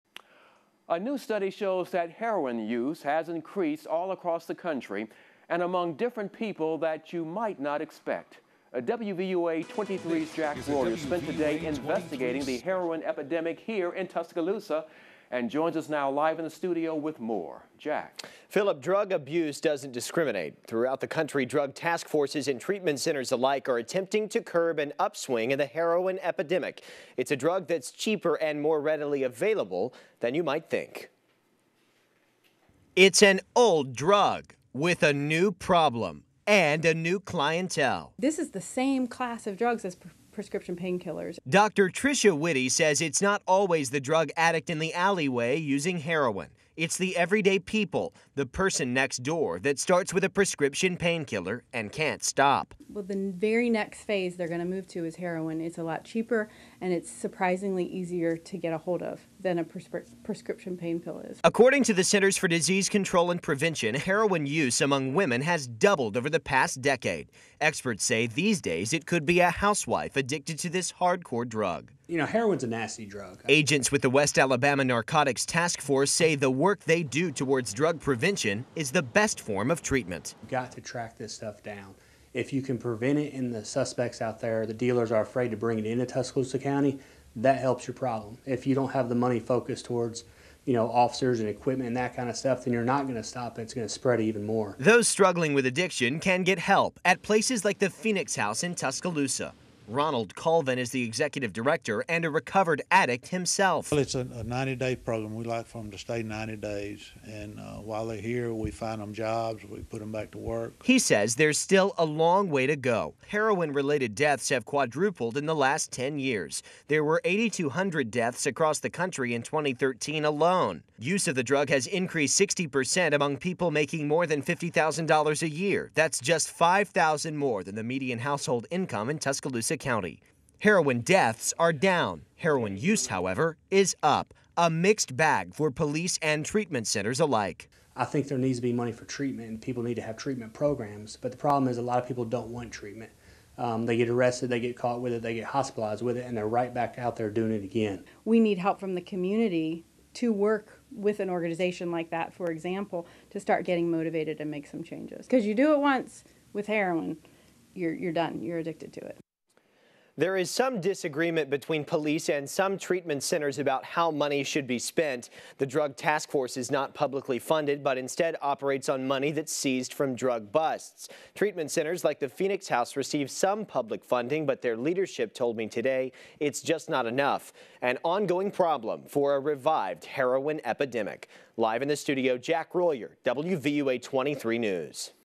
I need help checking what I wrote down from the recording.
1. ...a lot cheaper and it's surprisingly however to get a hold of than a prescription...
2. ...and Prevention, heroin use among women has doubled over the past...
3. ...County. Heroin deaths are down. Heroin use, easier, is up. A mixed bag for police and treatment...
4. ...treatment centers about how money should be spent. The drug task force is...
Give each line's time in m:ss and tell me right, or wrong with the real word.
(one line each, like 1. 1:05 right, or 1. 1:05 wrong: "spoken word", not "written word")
1. 0:55 wrong: "easier", not "however"
2. 1:03 right
3. 2:09 wrong: "however", not "easier"
4. 2:42 right.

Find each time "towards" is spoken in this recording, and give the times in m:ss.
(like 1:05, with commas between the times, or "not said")
1:17, 1:29.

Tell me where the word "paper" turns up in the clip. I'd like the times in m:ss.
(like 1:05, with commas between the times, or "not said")
not said.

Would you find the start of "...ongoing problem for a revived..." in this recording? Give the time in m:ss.
2:58.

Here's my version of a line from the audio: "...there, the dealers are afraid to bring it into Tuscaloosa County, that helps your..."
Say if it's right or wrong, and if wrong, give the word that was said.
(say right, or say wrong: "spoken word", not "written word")
right.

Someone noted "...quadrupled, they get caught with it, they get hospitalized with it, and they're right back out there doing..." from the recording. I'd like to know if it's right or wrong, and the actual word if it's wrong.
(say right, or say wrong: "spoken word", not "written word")
wrong: "arrested", not "quadrupled".